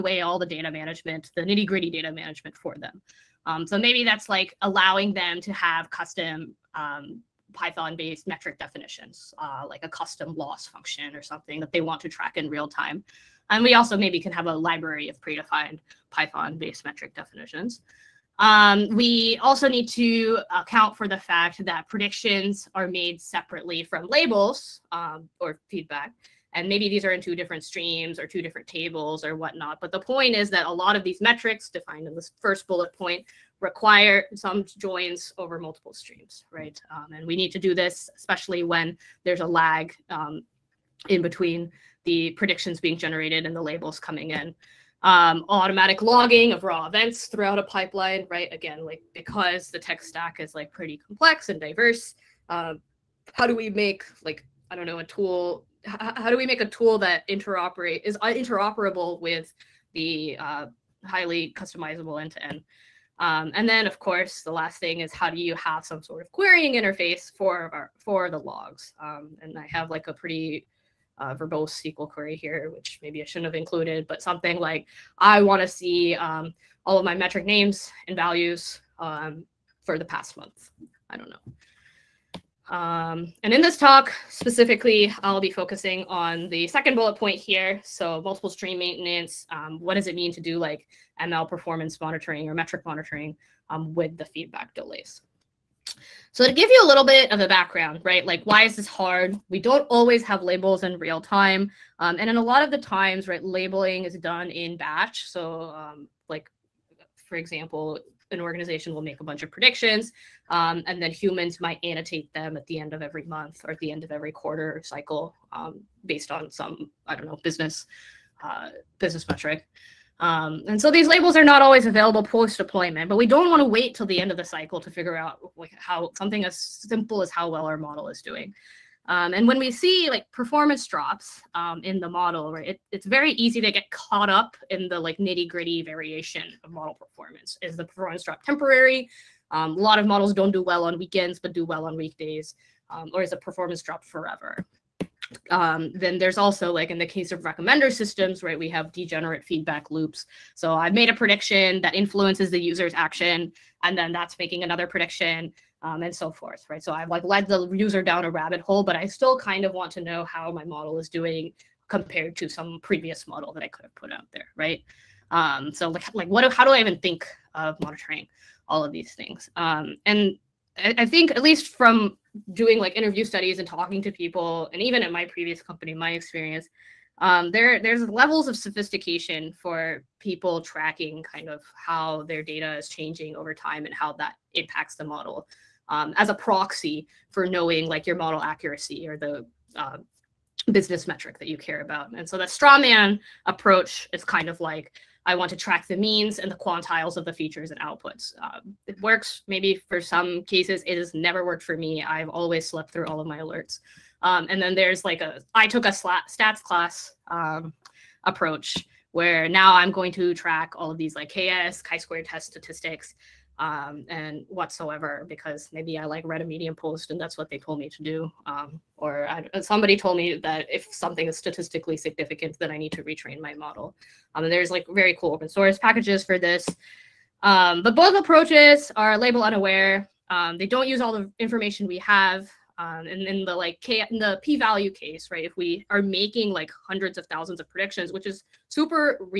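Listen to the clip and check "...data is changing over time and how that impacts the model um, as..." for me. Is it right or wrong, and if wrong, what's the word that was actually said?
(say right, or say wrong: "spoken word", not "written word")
right.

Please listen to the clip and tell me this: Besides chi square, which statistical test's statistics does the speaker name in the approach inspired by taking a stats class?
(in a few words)
KS.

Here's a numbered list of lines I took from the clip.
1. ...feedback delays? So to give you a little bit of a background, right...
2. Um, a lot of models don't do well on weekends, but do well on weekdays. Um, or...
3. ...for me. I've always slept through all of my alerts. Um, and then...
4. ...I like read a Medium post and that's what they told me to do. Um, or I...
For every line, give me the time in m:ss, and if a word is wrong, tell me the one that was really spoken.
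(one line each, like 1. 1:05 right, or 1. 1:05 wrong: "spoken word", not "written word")
1. 1:34 right
2. 2:19 right
3. 3:21 right
4. 3:35 right.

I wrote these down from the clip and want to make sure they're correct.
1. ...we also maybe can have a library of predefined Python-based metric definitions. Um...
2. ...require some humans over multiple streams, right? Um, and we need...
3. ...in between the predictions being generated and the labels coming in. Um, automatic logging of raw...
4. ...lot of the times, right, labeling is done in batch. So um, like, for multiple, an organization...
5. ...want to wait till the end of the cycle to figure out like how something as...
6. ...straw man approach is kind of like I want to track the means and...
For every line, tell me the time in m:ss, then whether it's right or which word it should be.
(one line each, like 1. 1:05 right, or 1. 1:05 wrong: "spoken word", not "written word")
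1. 0:13 right
2. 0:33 wrong: "joins", not "humans"
3. 0:41 right
4. 1:42 wrong: "example", not "multiple"
5. 2:03 right
6. 3:12 right.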